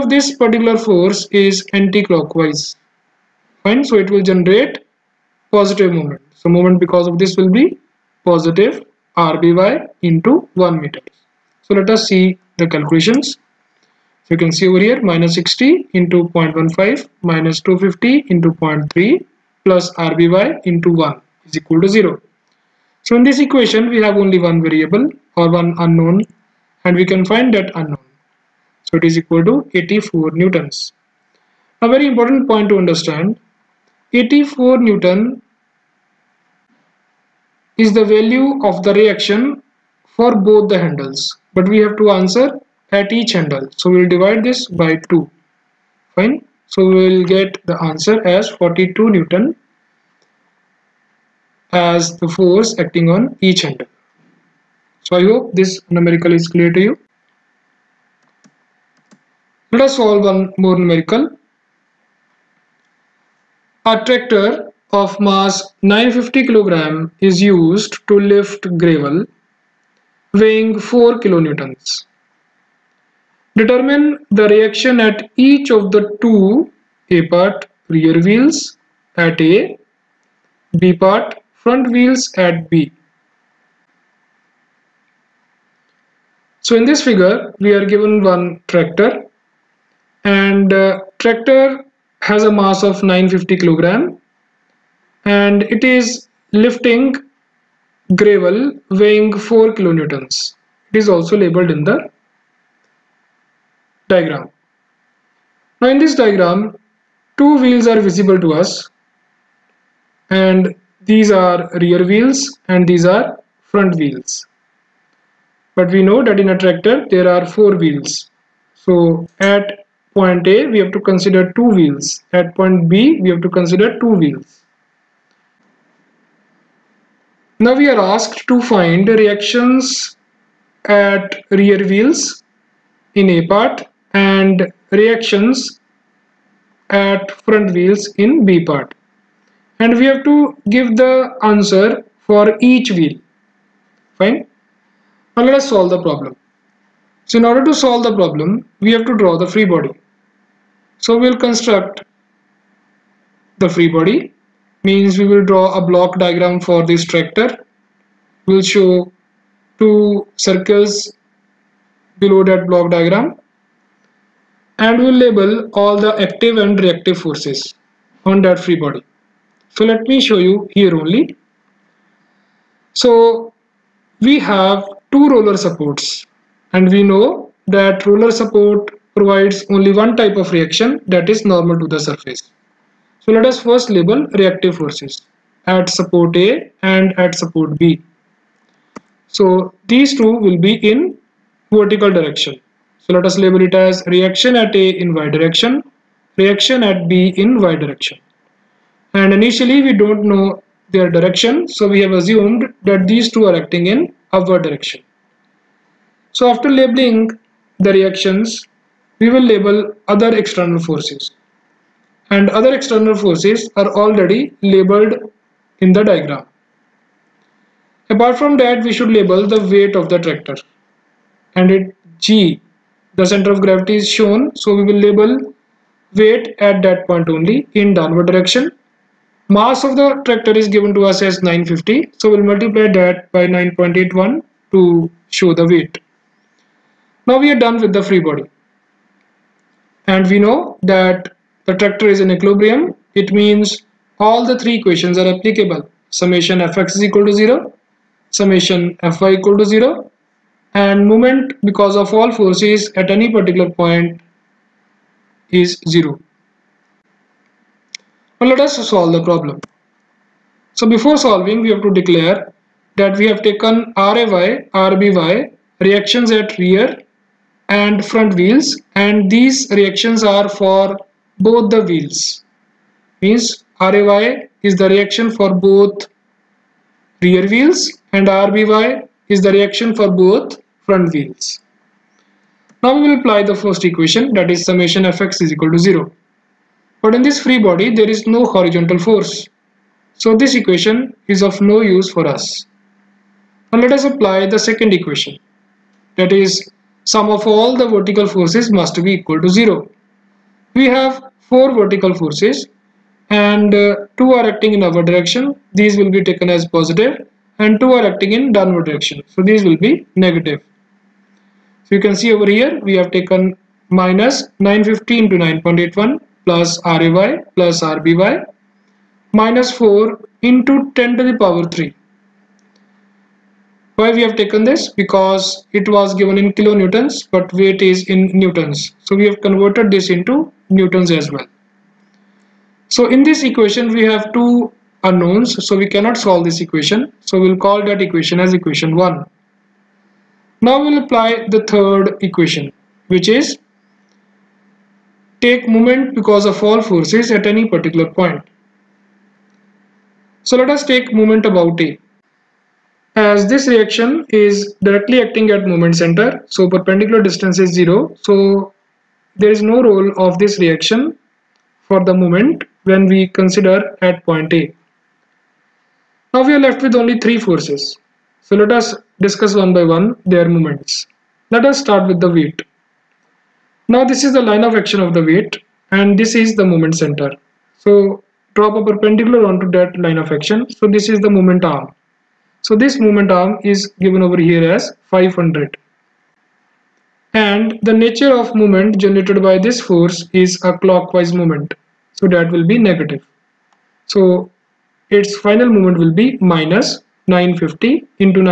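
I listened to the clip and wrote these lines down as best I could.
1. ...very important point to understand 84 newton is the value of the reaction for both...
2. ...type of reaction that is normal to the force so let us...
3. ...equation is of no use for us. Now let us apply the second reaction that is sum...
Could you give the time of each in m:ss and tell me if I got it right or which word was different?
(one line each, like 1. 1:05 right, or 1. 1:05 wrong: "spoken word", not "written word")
1. 0:31 right
2. 3:00 wrong: "surface", not "force"
3. 4:50 wrong: "equation", not "reaction".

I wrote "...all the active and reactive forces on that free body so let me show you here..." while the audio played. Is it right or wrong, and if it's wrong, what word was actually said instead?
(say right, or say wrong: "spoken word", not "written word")
right.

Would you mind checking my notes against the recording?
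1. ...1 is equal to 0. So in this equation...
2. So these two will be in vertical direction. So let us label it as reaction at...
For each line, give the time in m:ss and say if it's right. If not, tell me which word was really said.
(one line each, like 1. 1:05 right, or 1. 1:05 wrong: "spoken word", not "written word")
1. 0:20 right
2. 3:09 right.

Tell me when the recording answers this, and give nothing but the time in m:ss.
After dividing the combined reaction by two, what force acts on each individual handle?
0:48.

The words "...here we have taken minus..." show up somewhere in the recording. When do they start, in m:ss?
5:12.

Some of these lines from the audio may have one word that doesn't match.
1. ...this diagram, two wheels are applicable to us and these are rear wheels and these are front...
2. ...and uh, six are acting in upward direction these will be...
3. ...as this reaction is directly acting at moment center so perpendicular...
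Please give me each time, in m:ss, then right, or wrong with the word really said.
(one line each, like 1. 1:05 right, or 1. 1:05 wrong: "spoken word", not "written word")
1. 1:45 wrong: "visible", not "applicable"
2. 5:03 wrong: "two", not "six"
3. 5:53 right.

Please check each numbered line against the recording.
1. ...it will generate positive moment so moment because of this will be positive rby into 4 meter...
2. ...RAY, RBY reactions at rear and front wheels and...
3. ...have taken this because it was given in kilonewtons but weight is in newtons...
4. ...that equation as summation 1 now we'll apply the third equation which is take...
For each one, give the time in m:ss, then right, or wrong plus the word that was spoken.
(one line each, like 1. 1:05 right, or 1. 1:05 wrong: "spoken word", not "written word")
1. 0:04 wrong: "1", not "4"
2. 4:23 right
3. 5:24 right
4. 5:37 wrong: "equation", not "summation".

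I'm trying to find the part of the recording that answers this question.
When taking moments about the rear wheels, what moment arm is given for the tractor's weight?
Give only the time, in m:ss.
6:25.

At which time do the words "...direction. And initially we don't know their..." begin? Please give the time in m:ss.
3:17.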